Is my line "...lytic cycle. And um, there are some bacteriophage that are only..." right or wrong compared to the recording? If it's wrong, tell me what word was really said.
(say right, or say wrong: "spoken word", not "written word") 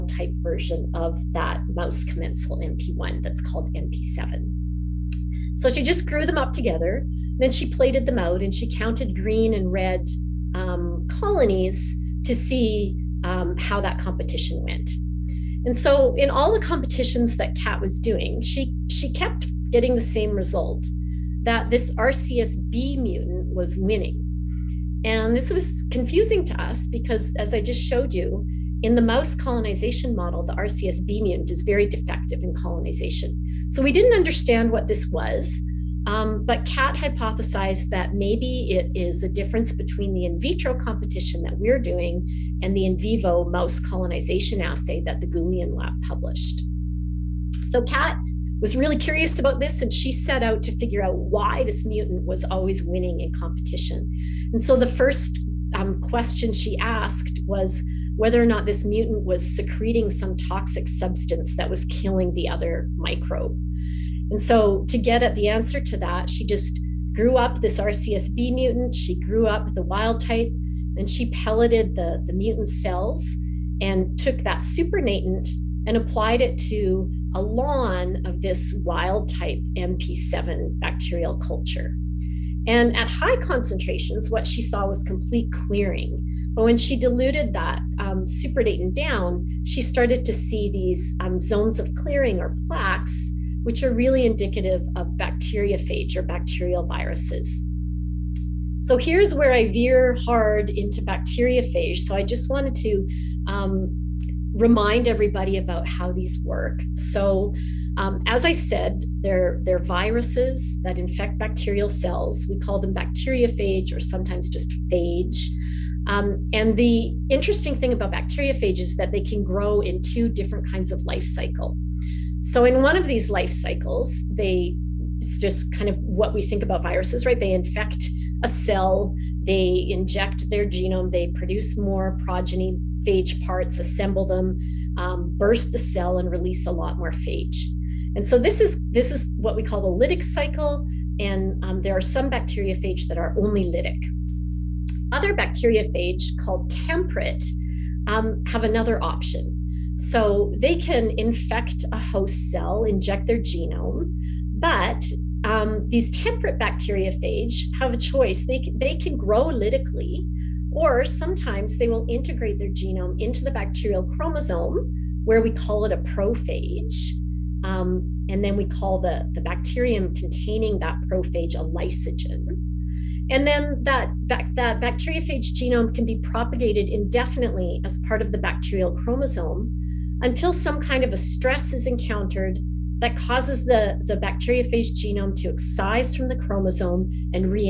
right.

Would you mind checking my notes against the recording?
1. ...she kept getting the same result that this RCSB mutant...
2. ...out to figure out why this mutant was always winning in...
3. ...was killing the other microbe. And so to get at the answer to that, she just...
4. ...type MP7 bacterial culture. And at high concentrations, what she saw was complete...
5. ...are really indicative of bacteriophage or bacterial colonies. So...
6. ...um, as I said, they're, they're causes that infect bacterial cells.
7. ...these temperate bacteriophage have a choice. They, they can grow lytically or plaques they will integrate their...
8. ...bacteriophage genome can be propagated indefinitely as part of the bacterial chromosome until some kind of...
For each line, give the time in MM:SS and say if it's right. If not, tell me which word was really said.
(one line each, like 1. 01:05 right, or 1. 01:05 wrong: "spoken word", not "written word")
1. 00:18 right
2. 00:50 right
3. 01:01 right
4. 01:19 right
5. 01:33 wrong: "viruses", not "colonies"
6. 01:47 wrong: "viruses", not "causes"
7. 02:35 wrong: "sometimes", not "plaques"
8. 02:54 right.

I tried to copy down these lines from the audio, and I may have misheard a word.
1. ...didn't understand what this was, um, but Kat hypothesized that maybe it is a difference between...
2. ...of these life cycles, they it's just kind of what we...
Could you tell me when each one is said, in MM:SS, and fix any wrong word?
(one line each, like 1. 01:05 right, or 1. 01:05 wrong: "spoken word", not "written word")
1. 00:33 right
2. 02:02 right.